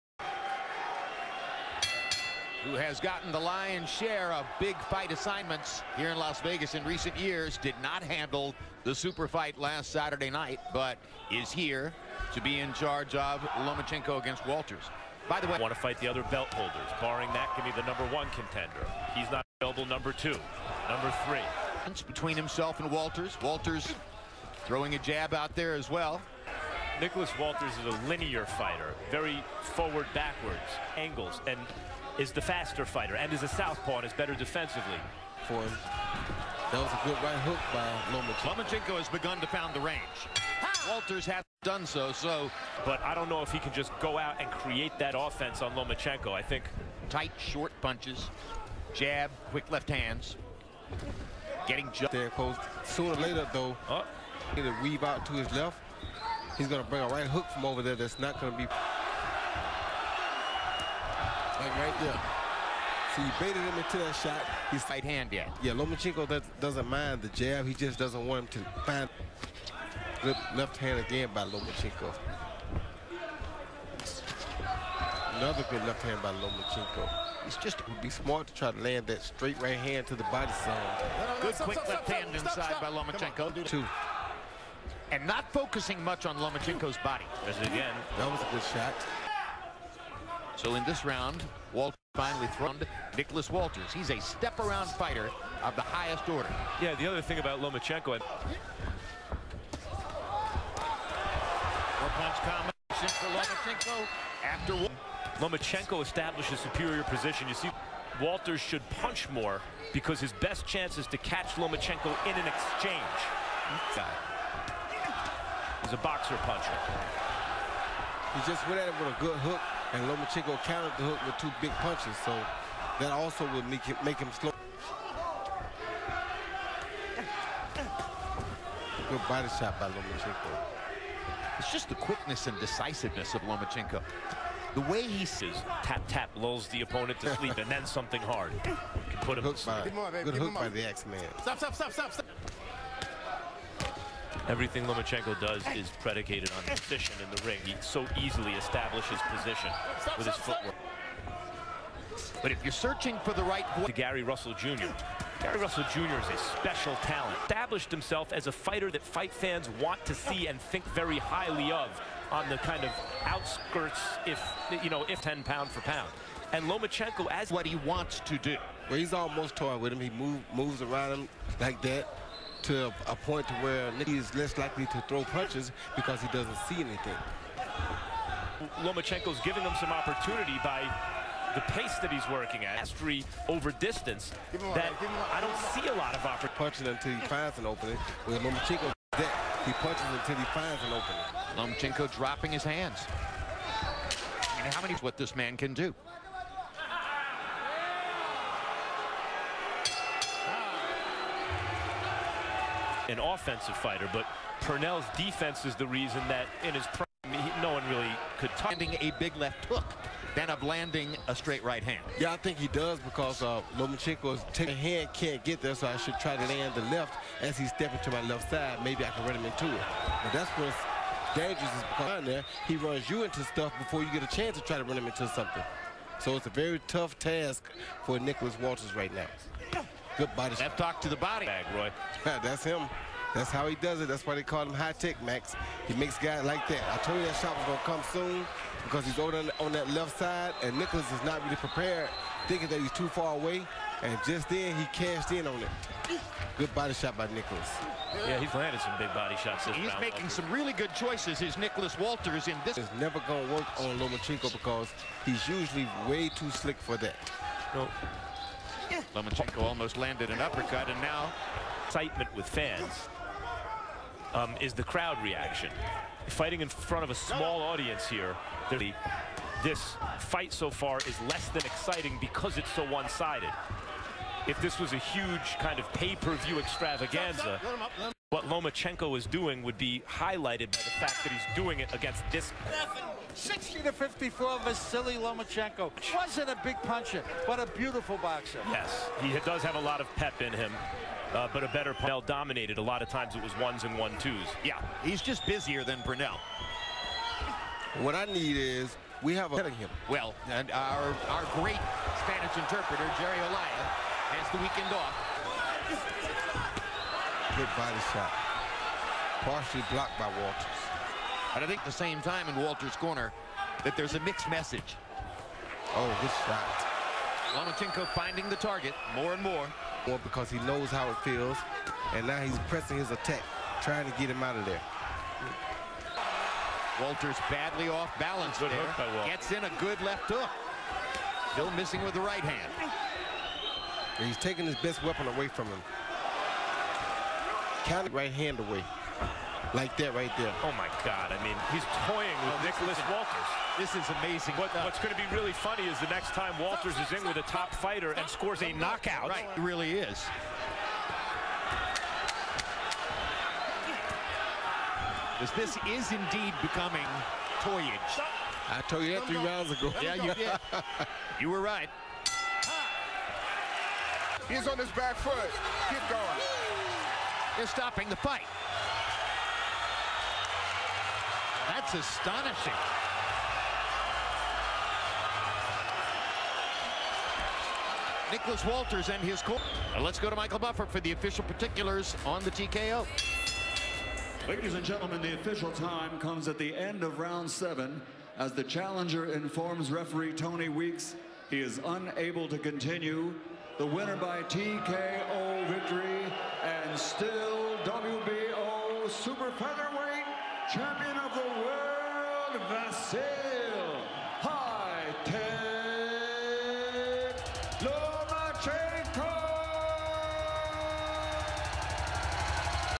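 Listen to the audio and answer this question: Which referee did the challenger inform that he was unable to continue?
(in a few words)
Tony Weeks.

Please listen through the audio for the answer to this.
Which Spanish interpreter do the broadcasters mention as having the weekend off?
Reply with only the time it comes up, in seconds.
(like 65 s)
303 s.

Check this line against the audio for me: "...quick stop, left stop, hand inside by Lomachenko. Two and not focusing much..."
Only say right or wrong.
right.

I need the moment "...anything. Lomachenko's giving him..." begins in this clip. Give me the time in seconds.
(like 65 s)
176 s.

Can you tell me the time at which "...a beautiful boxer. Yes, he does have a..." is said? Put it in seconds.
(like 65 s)
287 s.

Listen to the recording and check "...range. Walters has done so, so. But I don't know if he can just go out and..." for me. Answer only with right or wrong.
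right.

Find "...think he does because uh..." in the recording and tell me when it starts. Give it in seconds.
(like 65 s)
212 s.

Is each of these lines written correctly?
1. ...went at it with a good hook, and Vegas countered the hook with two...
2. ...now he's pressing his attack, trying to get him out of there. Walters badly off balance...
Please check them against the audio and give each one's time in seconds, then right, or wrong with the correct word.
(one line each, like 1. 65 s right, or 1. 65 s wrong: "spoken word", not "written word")
1. 118 s wrong: "Lomachenko", not "Vegas"
2. 322 s right.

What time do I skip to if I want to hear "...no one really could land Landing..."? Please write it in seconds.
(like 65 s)
207 s.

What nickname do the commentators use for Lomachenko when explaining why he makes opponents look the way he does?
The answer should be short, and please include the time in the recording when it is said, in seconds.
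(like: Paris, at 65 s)
High Tech, at 234 s.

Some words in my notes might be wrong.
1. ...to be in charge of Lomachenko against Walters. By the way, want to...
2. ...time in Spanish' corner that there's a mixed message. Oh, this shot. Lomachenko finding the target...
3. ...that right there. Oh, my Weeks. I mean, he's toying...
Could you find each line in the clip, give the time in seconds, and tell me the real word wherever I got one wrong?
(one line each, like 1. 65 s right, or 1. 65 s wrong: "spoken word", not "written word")
1. 12 s right
2. 312 s wrong: "Walters", not "Spanish"
3. 339 s wrong: "God", not "Weeks".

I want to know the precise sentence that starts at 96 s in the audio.
Yeah, the other thing about Lomachenko...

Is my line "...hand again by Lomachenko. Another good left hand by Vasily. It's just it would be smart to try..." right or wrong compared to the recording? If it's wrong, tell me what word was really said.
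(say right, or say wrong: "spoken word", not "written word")
wrong: "Lomachenko", not "Vasily".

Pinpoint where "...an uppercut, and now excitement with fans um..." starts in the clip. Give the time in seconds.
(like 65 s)
260 s.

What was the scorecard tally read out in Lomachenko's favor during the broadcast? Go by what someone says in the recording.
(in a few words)
60 to 54.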